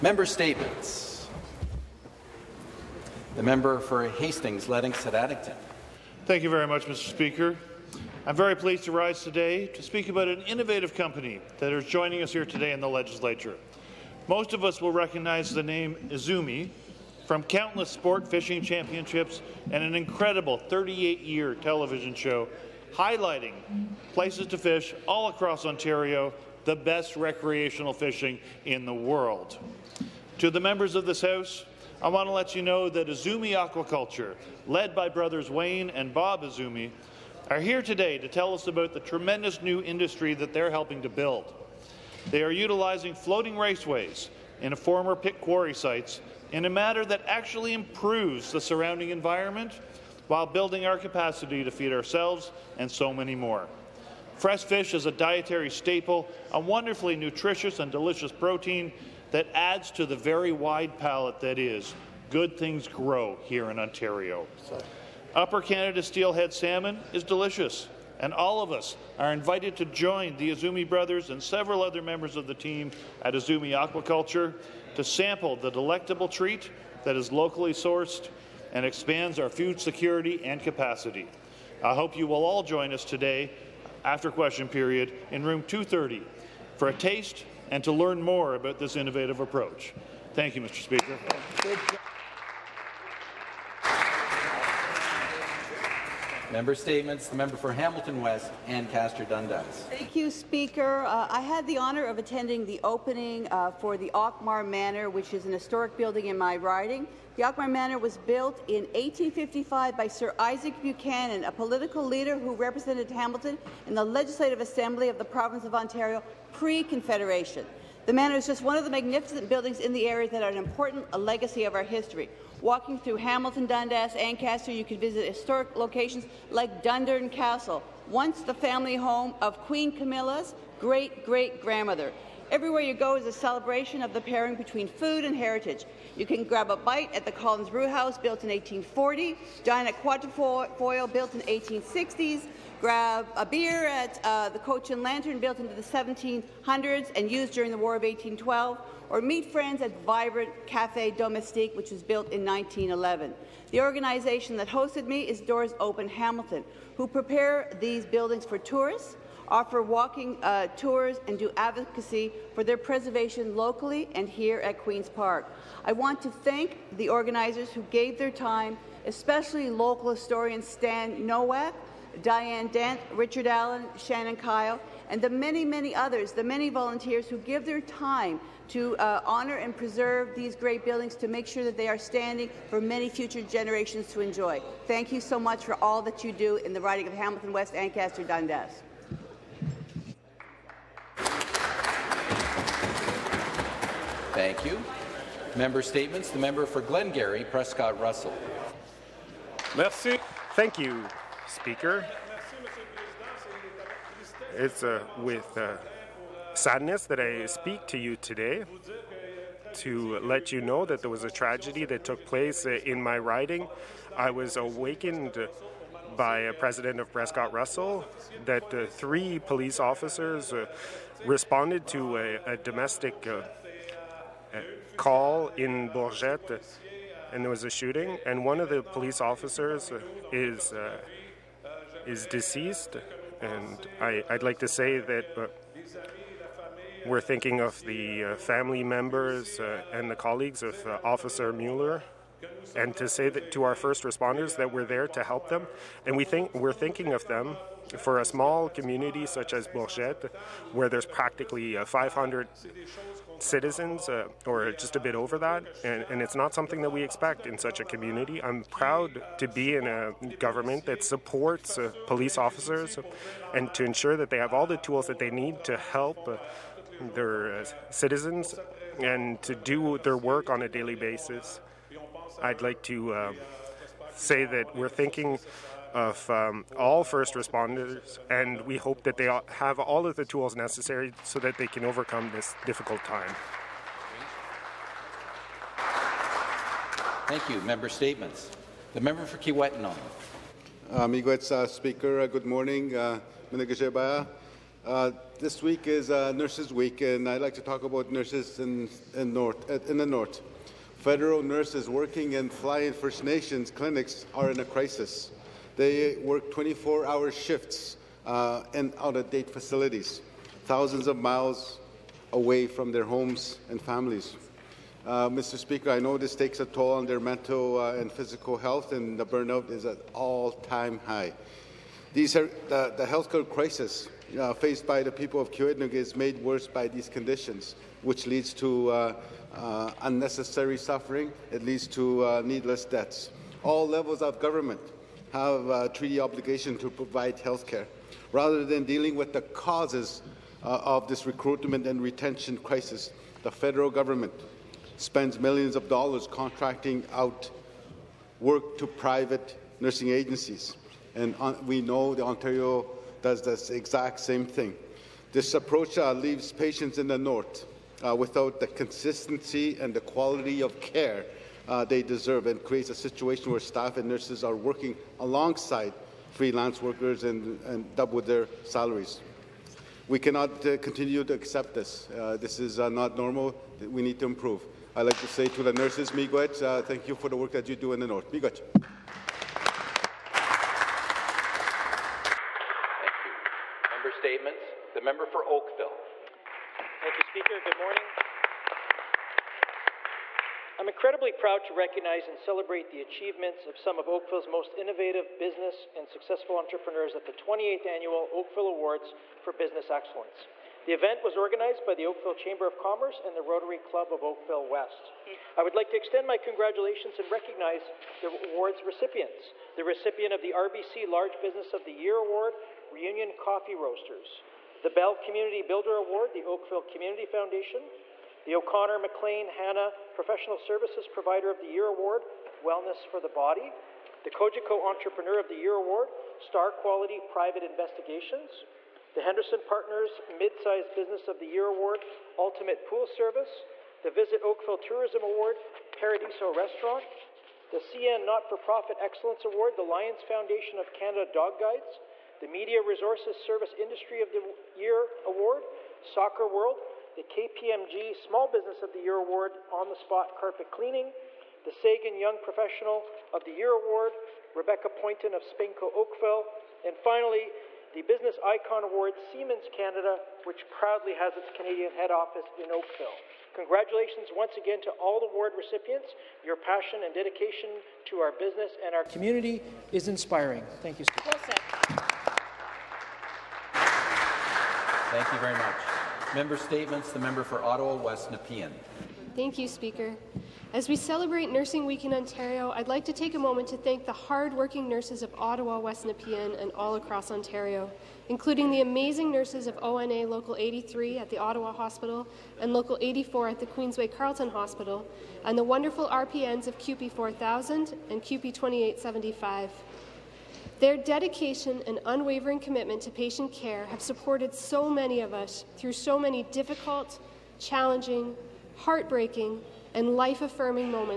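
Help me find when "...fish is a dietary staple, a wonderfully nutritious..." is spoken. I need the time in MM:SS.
00:54.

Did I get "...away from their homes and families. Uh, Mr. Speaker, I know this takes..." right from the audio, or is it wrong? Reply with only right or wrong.
right.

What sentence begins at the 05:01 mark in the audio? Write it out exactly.
Federal nurses working in fly-in First Nations clinics are in a crisis.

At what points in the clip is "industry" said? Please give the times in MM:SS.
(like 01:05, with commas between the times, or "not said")
00:39, 07:23.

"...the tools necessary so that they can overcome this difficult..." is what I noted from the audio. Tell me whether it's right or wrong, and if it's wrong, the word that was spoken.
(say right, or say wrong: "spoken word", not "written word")
right.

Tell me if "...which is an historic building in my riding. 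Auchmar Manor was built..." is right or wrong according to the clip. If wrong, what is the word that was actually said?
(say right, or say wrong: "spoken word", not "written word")
right.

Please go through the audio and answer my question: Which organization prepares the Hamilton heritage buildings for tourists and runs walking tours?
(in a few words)
Doors Open Hamilton.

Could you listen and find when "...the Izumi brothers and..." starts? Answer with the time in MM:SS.
01:10.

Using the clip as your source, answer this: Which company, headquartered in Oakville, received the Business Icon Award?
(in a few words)
Siemens Canada.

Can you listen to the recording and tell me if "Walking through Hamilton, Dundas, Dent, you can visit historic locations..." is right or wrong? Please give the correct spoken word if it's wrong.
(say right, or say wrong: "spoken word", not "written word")
wrong: "Ancaster", not "Dent".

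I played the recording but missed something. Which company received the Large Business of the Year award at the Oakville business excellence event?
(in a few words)
Reunion Coffee Roasters.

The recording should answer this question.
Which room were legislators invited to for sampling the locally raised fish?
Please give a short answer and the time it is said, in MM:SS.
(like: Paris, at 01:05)
Room 230, at 01:25.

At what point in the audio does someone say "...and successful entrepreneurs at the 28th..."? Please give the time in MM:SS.
06:35.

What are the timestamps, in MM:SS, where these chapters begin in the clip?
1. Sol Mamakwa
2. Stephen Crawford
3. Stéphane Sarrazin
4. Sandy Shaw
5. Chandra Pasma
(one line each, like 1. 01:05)
1. 04:48
2. 06:23
3. 03:15
4. 01:36
5. 07:54.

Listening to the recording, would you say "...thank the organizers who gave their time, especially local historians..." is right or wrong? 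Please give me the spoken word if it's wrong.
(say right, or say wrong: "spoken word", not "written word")
right.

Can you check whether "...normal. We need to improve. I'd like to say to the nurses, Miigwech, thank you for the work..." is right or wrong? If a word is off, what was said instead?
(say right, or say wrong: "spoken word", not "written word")
right.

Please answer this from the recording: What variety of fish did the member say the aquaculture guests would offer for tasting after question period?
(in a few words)
Upper Canada steelhead salmon.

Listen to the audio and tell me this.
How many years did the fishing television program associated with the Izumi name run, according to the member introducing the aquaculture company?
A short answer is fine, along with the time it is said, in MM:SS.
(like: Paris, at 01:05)
38, at 00:20.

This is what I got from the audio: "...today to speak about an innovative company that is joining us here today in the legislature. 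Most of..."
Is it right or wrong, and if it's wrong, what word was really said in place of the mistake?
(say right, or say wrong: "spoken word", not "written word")
right.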